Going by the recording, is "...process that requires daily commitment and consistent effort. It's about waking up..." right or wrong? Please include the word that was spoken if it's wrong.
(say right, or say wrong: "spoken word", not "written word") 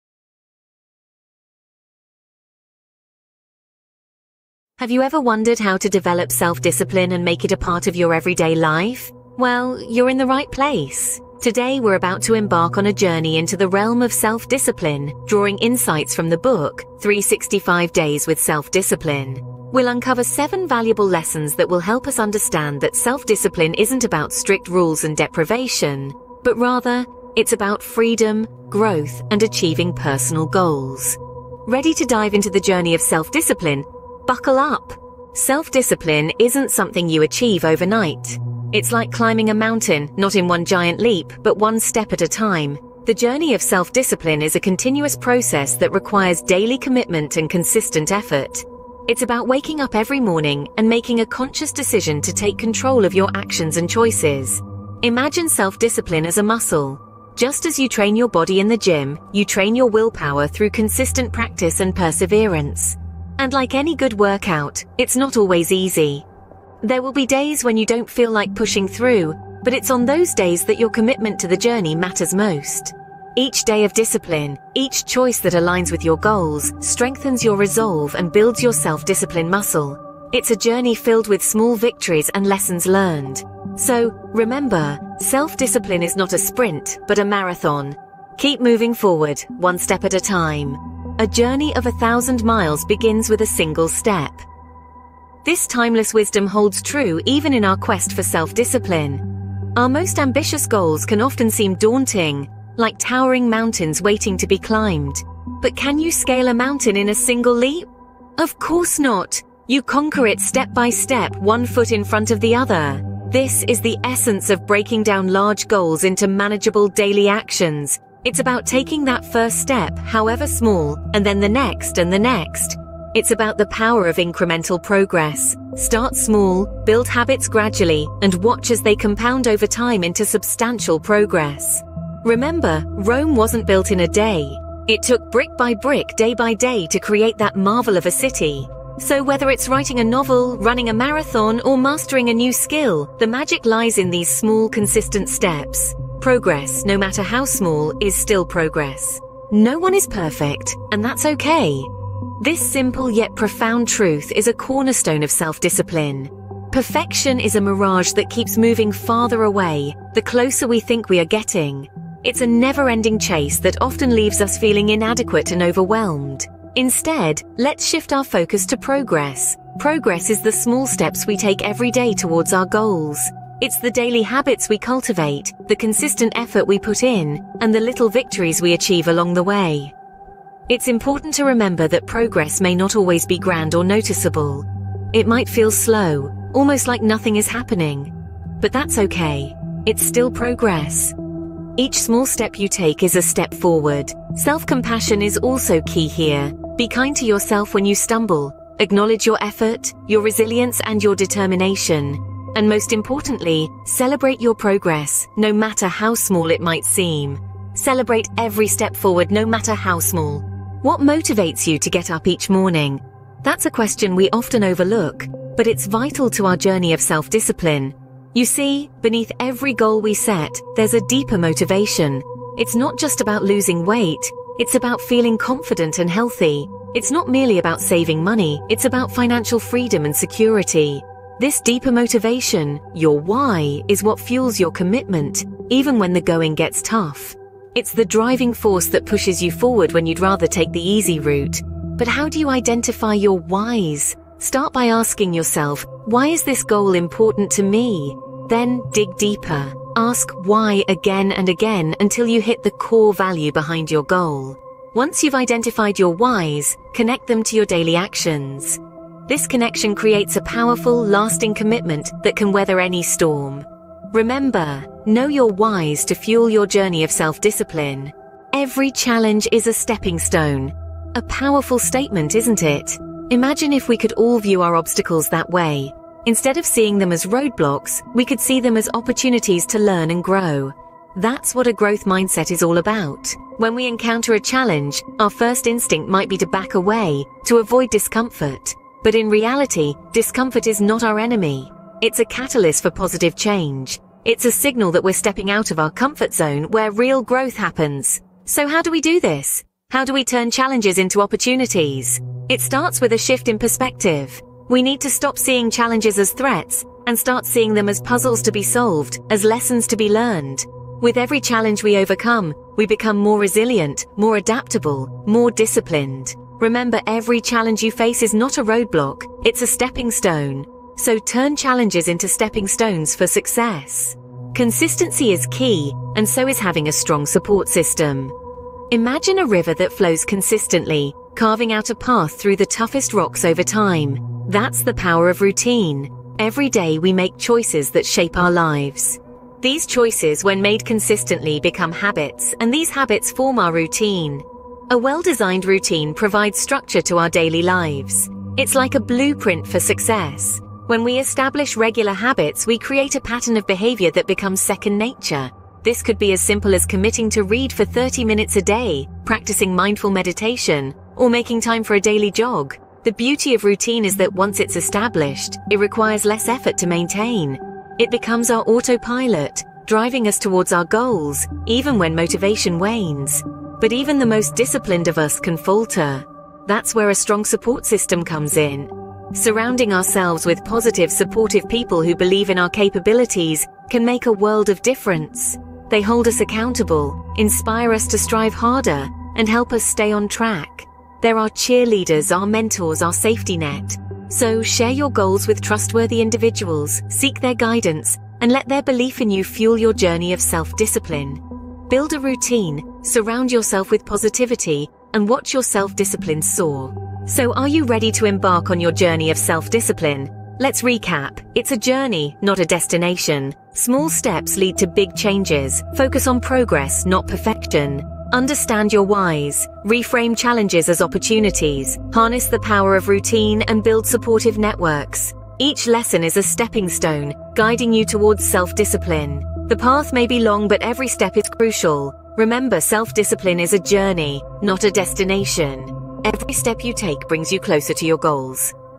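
right.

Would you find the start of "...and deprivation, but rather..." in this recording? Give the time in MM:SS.
00:25.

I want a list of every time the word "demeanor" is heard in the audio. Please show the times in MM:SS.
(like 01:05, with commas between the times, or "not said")
not said.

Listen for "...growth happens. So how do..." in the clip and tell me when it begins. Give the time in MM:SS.
04:57.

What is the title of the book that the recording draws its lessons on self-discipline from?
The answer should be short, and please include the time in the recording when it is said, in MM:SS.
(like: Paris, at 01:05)
365 Days with Self-Discipline, at 00:16.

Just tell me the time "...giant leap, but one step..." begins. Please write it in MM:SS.
00:40.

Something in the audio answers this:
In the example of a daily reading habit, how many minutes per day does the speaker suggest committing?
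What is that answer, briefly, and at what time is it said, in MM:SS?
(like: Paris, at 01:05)
30, at 05:57.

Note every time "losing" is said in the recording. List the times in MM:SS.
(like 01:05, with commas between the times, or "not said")
03:43.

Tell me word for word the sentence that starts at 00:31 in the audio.
Ready to dive into the journey of self-discipline, Buckle up.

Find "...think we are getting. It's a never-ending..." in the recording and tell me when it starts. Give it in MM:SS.
02:40.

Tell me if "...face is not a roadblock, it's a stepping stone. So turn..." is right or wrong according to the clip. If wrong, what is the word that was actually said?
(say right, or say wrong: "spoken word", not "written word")
right.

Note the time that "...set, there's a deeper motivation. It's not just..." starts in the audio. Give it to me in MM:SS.
03:40.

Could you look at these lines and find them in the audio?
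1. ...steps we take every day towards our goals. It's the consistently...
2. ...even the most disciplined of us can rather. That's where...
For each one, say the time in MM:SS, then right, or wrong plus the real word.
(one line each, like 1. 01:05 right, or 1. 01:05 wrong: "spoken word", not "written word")
1. 02:50 wrong: "daily", not "consistently"
2. 06:13 wrong: "falter", not "rather".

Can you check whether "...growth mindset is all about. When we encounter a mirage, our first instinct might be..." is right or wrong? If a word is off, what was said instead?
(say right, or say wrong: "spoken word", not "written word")
wrong: "challenge", not "mirage".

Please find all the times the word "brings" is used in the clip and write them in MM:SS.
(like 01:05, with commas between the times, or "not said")
07:17.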